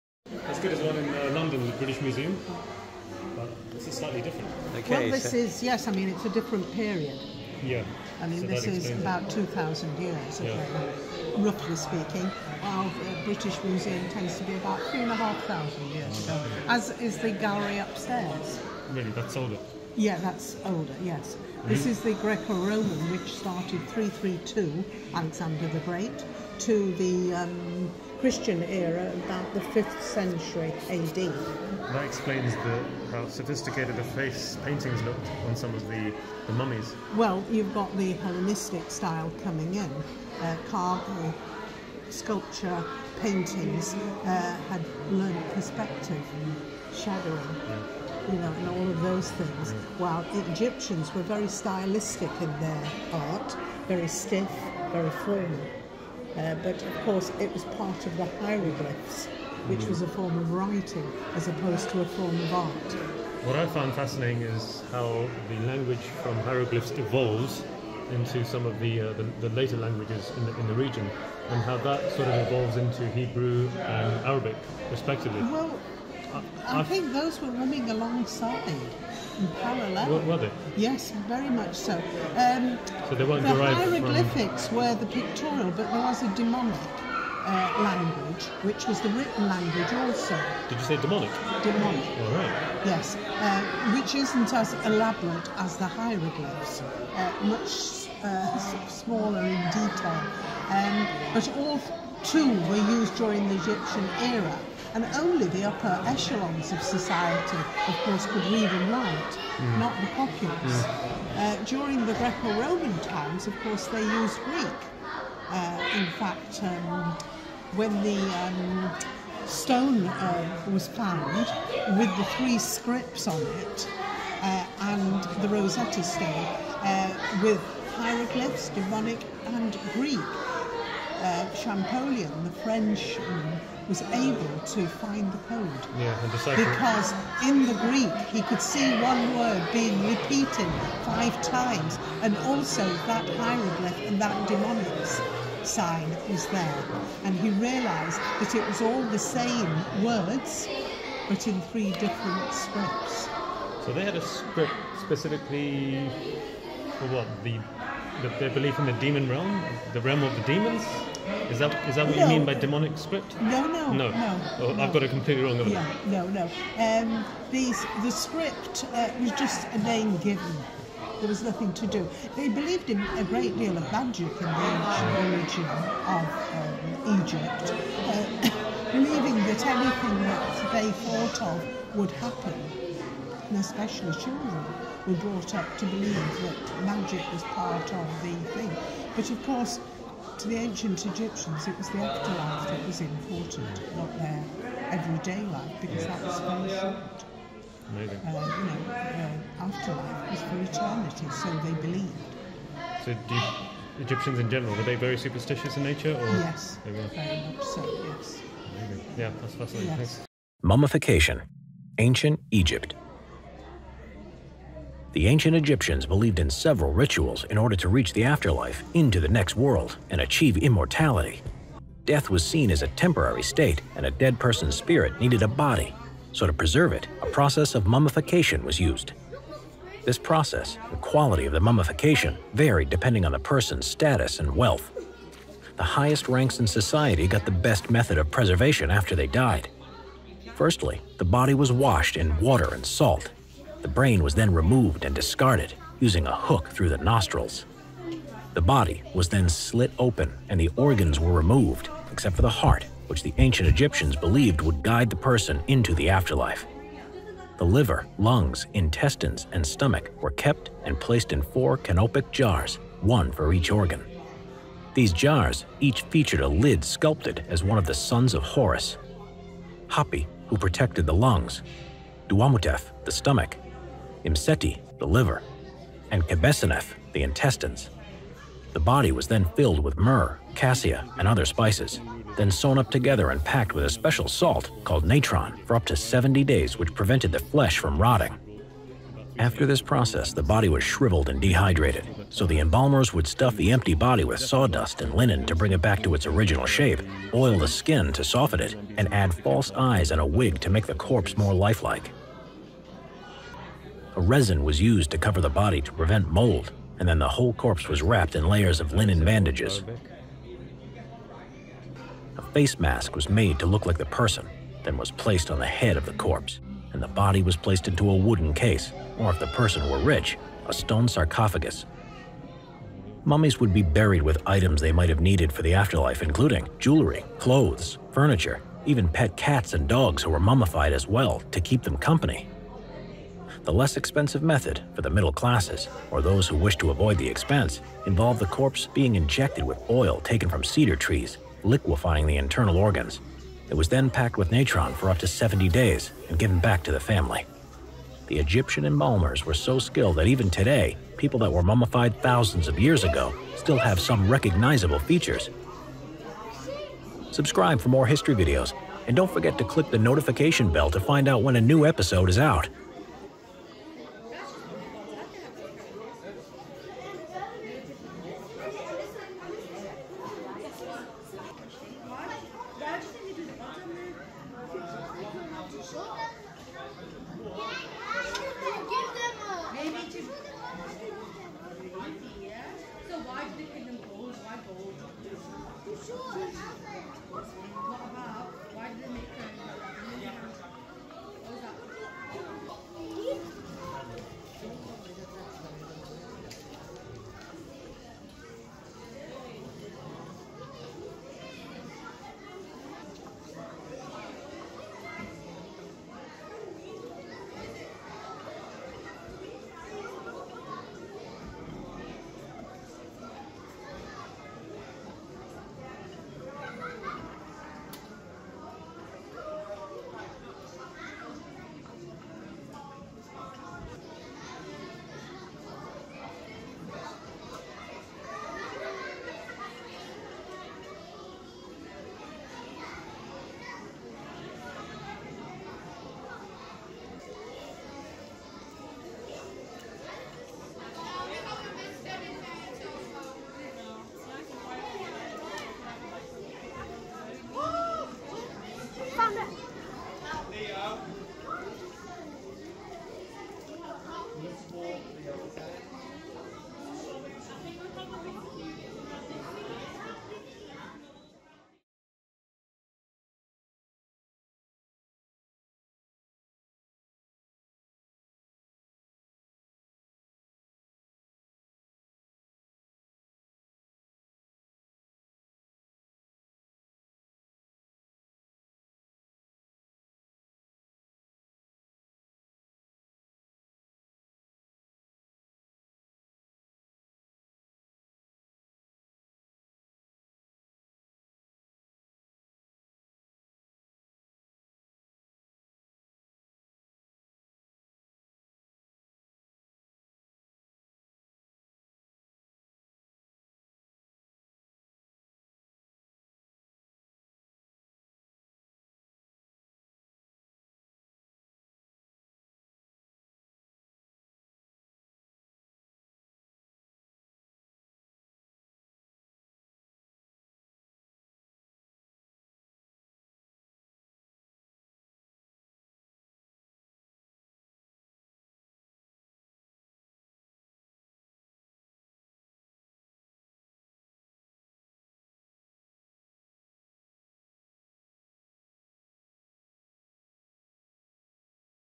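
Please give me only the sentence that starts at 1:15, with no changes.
Well, I, I, I think those were running alongside parallel.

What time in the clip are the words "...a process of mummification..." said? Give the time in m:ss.
3:47.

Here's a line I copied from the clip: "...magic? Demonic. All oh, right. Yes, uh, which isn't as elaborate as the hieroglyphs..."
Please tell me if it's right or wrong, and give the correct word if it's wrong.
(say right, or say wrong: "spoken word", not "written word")
wrong: "demonic", not "magic".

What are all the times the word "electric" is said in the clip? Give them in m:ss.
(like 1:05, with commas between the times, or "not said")
not said.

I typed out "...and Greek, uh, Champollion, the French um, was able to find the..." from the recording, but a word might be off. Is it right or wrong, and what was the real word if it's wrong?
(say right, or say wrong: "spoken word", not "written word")
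right.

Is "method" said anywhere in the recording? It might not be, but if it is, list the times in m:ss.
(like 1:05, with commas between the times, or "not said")
3:57, 5:34.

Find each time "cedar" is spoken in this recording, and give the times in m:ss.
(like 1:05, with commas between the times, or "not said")
5:40.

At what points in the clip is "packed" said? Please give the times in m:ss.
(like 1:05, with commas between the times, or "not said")
4:43, 5:44.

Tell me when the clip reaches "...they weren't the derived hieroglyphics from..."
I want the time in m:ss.
1:23.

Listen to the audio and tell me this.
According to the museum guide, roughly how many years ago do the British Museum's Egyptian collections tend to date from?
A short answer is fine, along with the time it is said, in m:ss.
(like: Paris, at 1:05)
3,500 years, at 0:14.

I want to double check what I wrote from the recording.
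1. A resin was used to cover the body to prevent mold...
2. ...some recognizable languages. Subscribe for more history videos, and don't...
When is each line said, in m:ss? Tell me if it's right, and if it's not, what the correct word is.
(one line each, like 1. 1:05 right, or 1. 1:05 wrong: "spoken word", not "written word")
1. 5:04 right
2. 5:53 wrong: "features", not "languages".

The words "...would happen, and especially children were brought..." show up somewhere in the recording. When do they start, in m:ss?
3:01.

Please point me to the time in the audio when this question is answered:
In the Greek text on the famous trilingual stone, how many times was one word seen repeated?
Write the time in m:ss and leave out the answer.
2:21.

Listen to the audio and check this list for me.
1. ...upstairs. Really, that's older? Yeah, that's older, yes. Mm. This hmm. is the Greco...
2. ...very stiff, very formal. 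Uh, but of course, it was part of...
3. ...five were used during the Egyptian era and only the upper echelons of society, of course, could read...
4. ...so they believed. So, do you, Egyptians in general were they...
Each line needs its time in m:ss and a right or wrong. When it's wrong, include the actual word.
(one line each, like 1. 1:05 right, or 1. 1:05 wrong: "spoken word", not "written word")
1. 0:17 right
2. 0:53 right
3. 1:42 wrong: "two", not "five"
4. 3:21 right.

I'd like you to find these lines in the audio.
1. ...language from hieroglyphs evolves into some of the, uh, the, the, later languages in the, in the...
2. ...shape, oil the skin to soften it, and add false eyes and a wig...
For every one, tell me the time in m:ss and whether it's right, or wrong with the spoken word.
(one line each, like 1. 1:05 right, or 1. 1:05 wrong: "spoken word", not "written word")
1. 1:05 right
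2. 4:56 right.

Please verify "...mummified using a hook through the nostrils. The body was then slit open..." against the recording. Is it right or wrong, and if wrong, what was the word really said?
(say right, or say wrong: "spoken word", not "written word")
wrong: "discarded", not "mummified".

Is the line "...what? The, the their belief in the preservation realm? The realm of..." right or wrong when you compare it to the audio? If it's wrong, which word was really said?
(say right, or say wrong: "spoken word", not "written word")
wrong: "demon", not "preservation".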